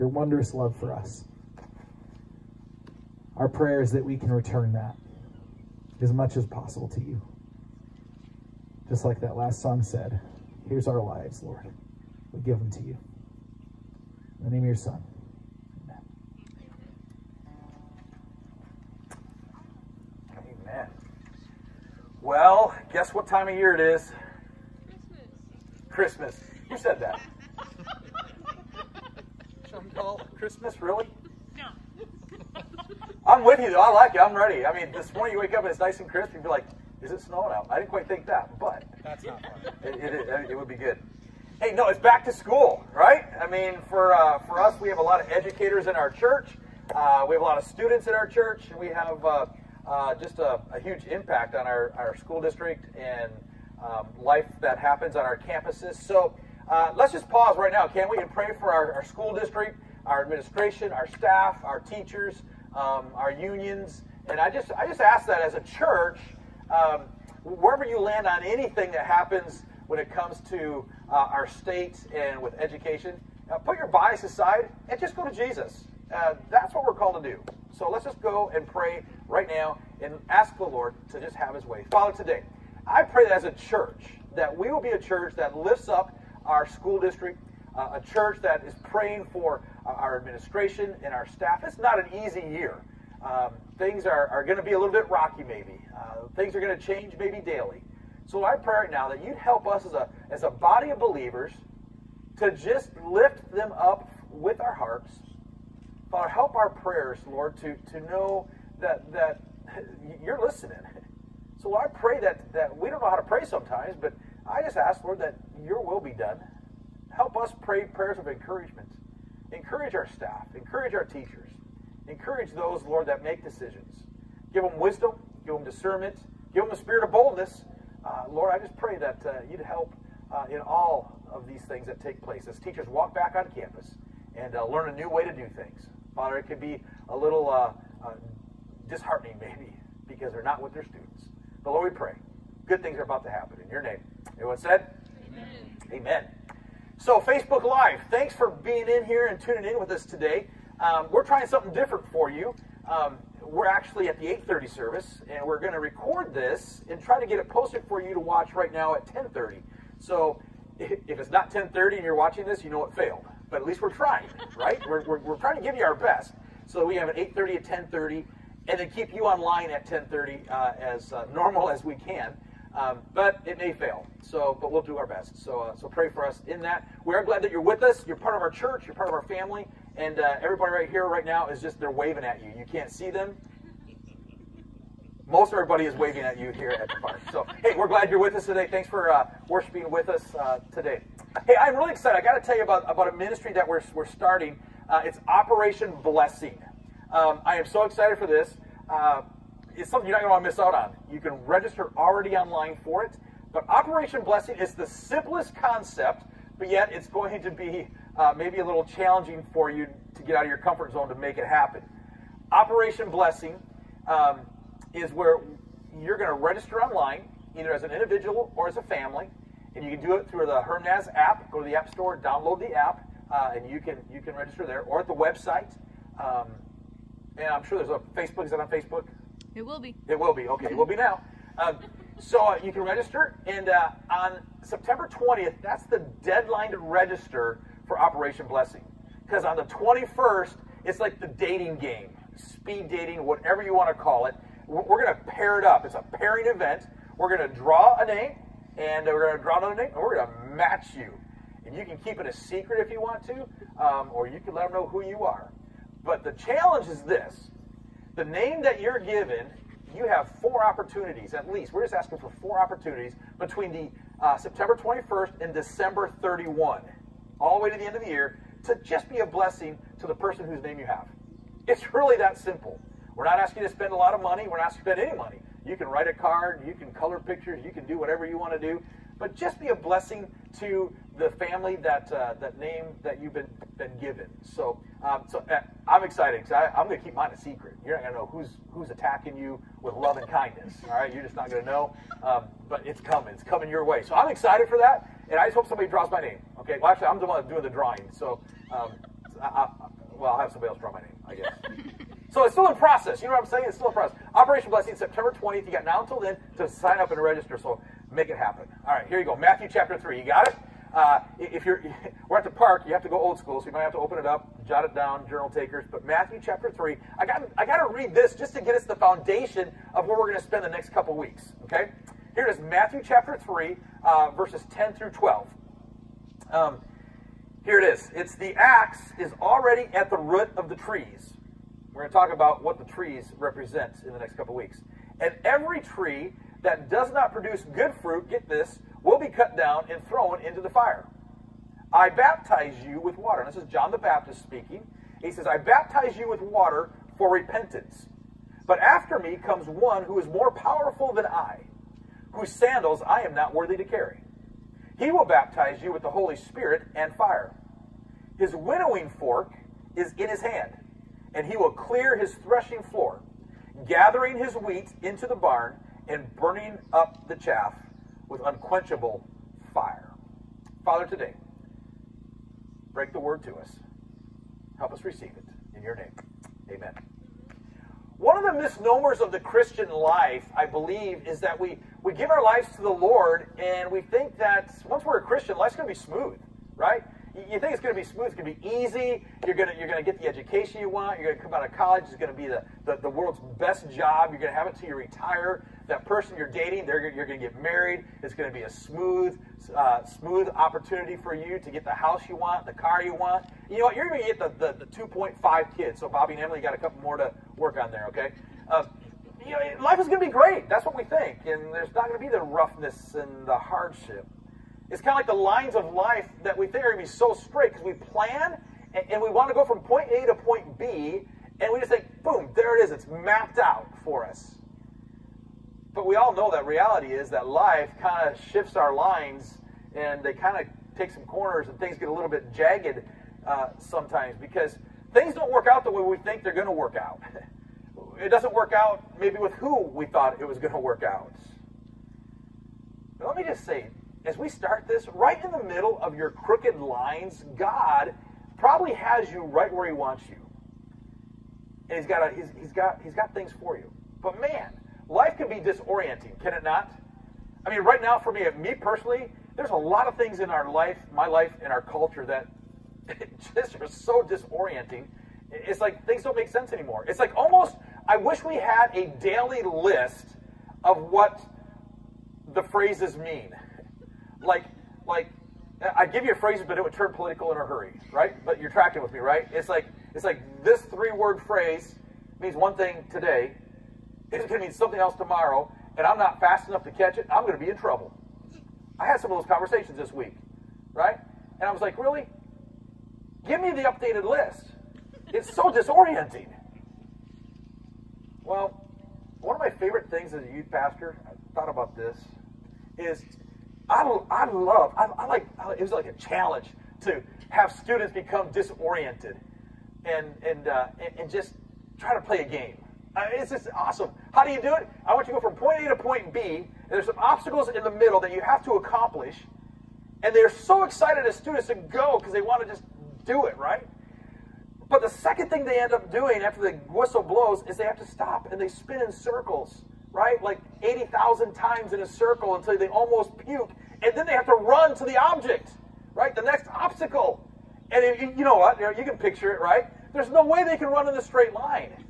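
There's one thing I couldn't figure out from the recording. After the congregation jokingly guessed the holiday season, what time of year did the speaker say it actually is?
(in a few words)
Back to school.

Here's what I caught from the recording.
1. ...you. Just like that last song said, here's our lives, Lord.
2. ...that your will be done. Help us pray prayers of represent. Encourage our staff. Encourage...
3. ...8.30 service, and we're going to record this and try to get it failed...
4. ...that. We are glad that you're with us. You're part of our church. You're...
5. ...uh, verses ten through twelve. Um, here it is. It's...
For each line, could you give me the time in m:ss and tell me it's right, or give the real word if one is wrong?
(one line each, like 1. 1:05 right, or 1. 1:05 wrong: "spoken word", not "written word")
1. 0:07 right
2. 1:55 wrong: "encouragement", not "represent"
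3. 2:34 wrong: "posted", not "failed"
4. 2:56 right
5. 5:24 right.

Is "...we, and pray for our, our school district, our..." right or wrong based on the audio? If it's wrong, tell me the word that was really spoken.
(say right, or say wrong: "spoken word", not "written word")
right.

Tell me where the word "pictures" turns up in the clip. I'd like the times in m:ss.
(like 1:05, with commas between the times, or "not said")
4:37, 8:59.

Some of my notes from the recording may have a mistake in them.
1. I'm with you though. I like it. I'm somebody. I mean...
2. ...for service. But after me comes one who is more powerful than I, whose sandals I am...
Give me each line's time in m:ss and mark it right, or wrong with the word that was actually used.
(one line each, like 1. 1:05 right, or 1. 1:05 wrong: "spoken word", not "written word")
1. 0:33 wrong: "ready", not "somebody"
2. 5:47 wrong: "repentance", not "service".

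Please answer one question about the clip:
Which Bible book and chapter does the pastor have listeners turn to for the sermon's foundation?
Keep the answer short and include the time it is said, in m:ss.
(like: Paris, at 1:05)
Matthew 3, at 5:09.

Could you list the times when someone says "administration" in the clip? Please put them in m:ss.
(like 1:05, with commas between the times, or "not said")
1:00, 1:30.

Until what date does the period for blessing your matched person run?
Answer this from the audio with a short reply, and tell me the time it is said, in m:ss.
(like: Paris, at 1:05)
December 31, at 4:25.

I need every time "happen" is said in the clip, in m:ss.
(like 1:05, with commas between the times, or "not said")
0:54, 1:09, 2:23, 3:31, 5:08.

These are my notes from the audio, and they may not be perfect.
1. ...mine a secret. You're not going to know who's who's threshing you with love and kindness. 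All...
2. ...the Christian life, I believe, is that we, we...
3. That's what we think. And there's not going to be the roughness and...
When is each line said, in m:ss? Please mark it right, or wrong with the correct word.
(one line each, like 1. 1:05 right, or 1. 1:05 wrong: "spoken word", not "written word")
1. 4:47 wrong: "attacking", not "threshing"
2. 6:19 right
3. 6:50 right.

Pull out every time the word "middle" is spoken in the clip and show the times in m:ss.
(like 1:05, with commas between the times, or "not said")
7:25, 8:37.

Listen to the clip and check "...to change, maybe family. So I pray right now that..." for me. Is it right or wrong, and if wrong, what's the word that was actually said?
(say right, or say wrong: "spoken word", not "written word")
wrong: "daily", not "family".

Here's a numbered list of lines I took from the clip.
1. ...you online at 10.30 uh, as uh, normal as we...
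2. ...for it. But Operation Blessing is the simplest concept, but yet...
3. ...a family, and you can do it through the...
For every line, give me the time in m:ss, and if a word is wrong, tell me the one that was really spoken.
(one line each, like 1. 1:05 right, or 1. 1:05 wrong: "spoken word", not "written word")
1. 2:49 right
2. 3:22 right
3. 3:38 right.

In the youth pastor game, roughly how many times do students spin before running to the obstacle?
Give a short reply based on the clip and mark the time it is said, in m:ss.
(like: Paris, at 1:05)
80,000, at 8:50.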